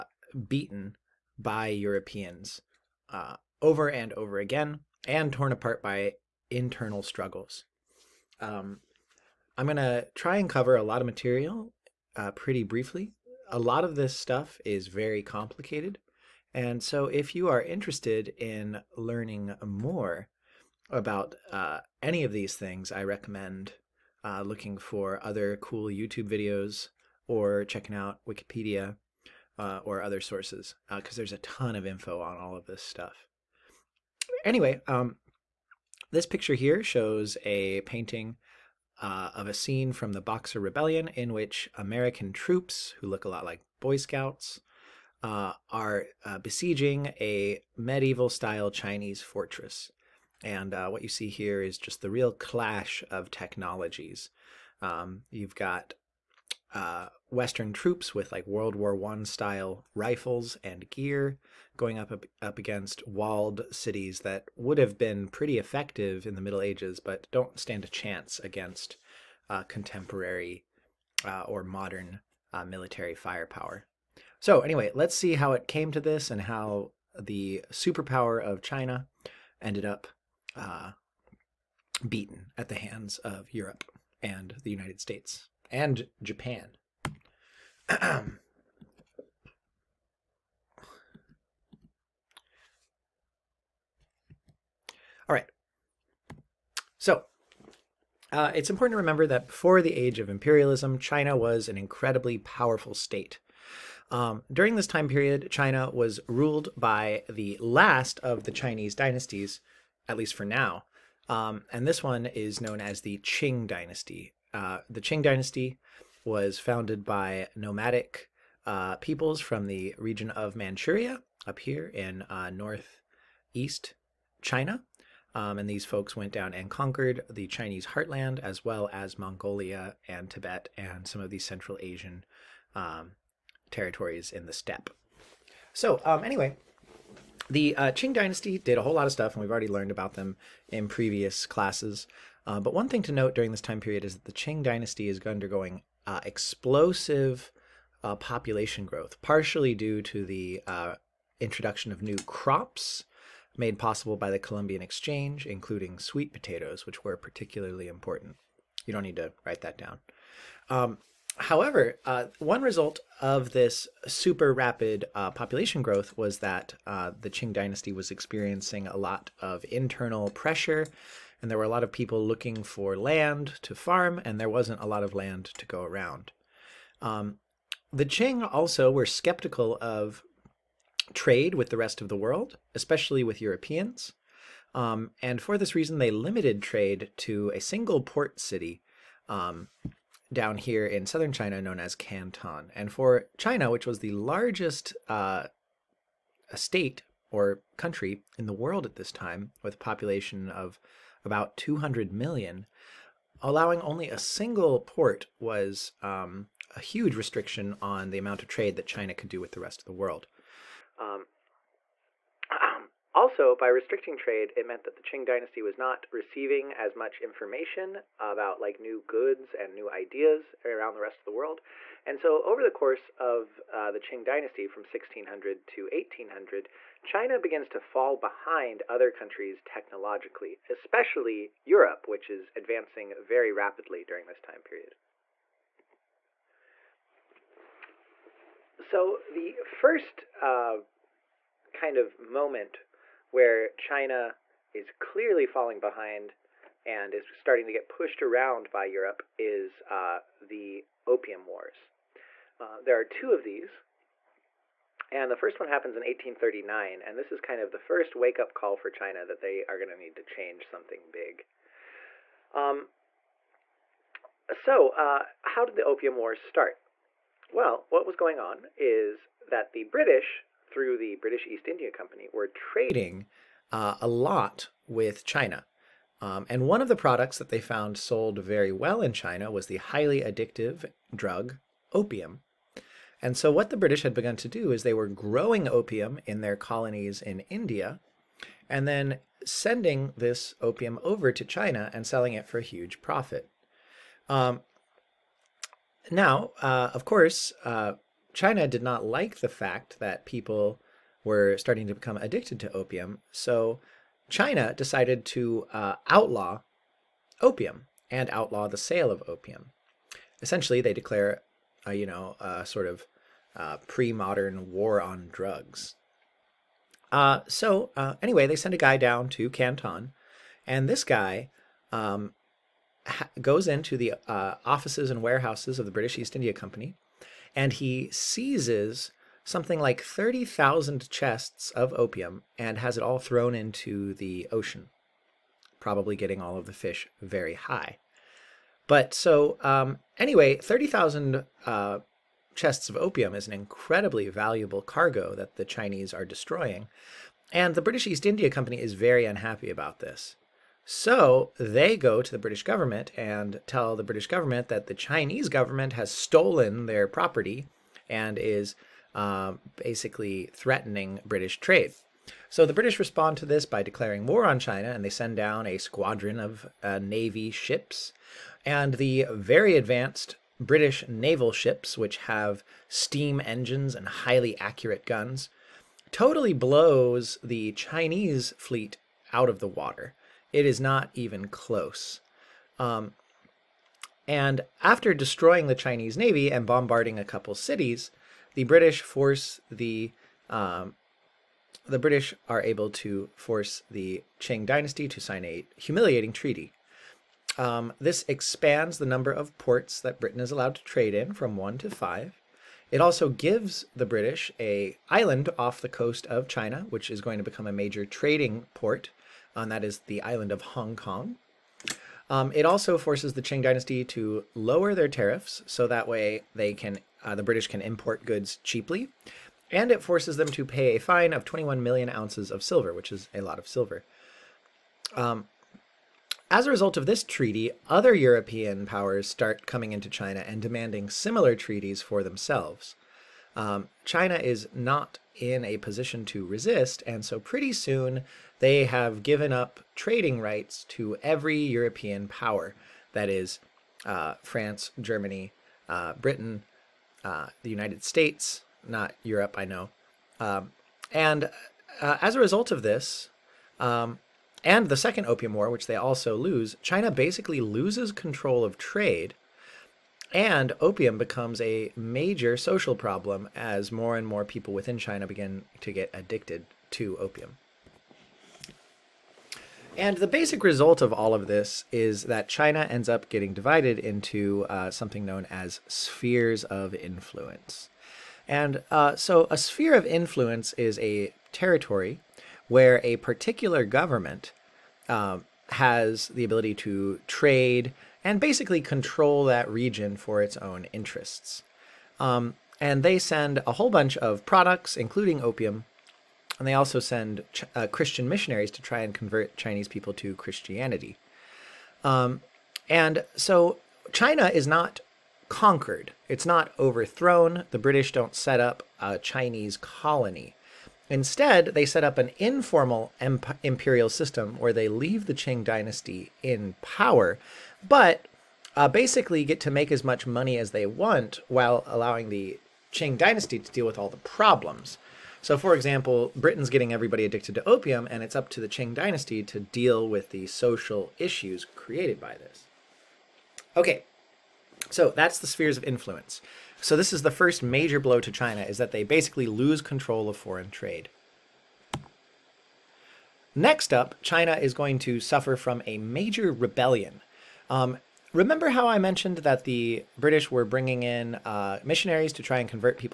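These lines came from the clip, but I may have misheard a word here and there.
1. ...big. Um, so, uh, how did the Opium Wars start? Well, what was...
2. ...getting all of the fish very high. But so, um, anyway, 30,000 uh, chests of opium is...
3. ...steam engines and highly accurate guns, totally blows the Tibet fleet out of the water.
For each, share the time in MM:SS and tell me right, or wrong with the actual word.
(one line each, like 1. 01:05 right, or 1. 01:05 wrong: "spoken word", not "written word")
1. 04:21 right
2. 05:36 right
3. 06:12 wrong: "Chinese", not "Tibet".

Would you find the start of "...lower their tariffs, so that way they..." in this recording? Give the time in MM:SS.
06:54.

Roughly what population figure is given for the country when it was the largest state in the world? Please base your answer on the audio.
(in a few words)
200 million.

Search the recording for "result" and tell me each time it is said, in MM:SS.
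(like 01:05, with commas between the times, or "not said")
02:42, 07:06, 07:32, 07:50.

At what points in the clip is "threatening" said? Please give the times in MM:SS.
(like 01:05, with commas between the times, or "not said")
06:00.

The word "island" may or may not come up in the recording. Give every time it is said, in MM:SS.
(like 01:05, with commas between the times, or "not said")
06:45, 06:50.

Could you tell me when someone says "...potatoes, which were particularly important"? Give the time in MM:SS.
02:36.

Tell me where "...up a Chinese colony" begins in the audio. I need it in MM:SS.
08:28.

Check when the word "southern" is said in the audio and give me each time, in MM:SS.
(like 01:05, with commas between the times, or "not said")
03:11.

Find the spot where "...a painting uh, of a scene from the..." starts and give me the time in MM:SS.
00:37.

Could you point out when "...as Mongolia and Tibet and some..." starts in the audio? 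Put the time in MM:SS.
02:08.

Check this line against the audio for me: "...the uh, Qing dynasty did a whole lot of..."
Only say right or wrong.
right.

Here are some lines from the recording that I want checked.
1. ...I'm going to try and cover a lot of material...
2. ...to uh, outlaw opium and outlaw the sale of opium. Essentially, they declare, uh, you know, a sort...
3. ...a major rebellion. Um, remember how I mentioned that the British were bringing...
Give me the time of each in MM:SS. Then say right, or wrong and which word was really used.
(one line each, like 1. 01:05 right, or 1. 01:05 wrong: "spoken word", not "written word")
1. 00:09 right
2. 05:05 right
3. 09:05 right.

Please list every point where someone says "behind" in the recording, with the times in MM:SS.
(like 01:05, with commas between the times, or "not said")
03:48, 04:05.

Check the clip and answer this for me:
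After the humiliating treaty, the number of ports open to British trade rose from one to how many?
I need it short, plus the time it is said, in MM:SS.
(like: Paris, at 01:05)
5, at 06:41.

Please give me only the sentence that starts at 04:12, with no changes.
Uh, there are two of these.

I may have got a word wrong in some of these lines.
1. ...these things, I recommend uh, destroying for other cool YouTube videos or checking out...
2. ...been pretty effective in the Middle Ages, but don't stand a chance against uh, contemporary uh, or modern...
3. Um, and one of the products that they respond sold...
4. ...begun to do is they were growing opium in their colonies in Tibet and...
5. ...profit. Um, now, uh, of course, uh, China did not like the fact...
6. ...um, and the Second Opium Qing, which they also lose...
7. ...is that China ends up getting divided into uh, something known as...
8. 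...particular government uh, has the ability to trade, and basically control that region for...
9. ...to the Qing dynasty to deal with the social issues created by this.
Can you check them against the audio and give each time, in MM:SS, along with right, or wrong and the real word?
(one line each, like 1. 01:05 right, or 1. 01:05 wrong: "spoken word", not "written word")
1. 00:22 wrong: "looking", not "destroying"
2. 01:04 right
3. 04:36 wrong: "found", not "respond"
4. 04:44 wrong: "India", not "Tibet"
5. 04:53 right
6. 07:33 wrong: "War", not "Qing"
7. 07:51 right
8. 08:03 right
9. 08:48 right.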